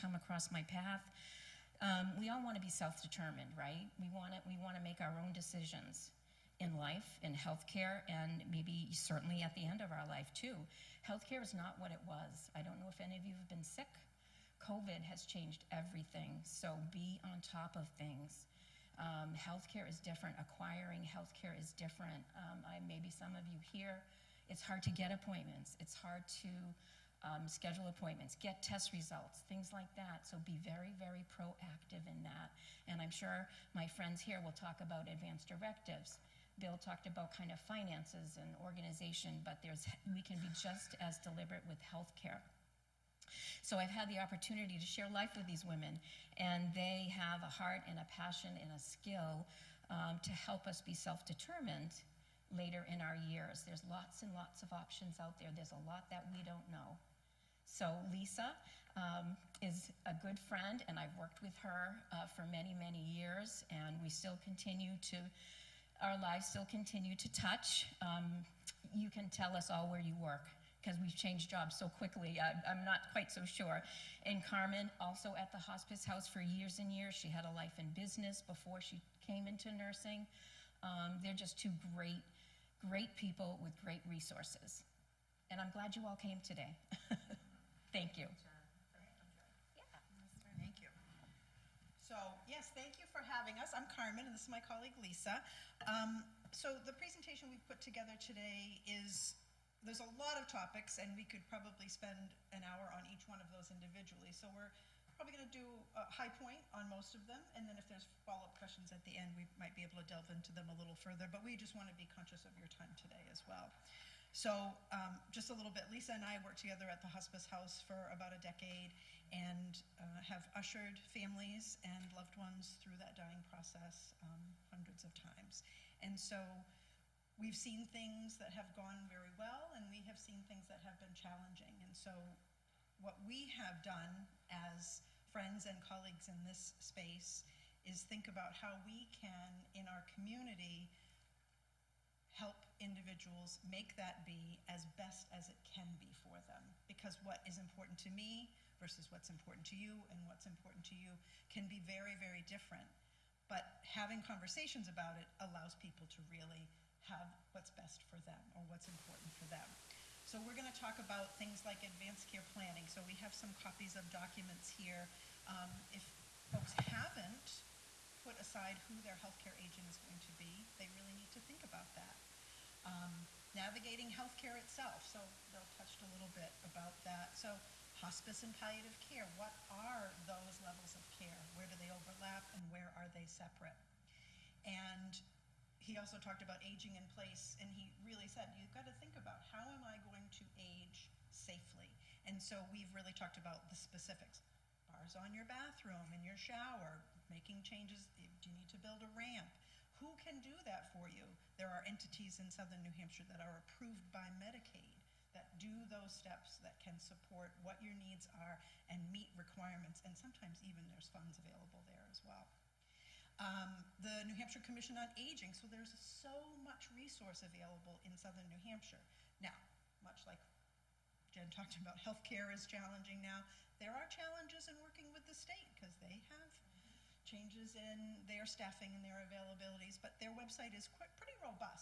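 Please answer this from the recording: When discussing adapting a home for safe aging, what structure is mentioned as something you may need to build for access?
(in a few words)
a ramp.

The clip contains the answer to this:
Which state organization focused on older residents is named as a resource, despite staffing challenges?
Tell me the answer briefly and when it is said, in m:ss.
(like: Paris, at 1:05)
New Hampshire Commission on Aging, at 3:34.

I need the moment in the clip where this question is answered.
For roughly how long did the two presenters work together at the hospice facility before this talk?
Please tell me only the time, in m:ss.
1:58.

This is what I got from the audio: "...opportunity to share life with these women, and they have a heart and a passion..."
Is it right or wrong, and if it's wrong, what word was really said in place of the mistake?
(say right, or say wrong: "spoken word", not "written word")
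right.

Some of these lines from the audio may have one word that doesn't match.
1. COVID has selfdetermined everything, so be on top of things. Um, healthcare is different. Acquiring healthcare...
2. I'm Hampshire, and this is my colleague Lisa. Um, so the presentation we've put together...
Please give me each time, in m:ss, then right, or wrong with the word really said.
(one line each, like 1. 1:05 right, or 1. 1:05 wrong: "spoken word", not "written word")
1. 0:14 wrong: "changed", not "selfdetermined"
2. 1:33 wrong: "Carmen", not "Hampshire".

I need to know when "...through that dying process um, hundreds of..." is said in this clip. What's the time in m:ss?
2:02.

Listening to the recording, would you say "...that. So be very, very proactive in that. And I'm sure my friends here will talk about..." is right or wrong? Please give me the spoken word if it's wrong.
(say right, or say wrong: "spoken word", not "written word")
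right.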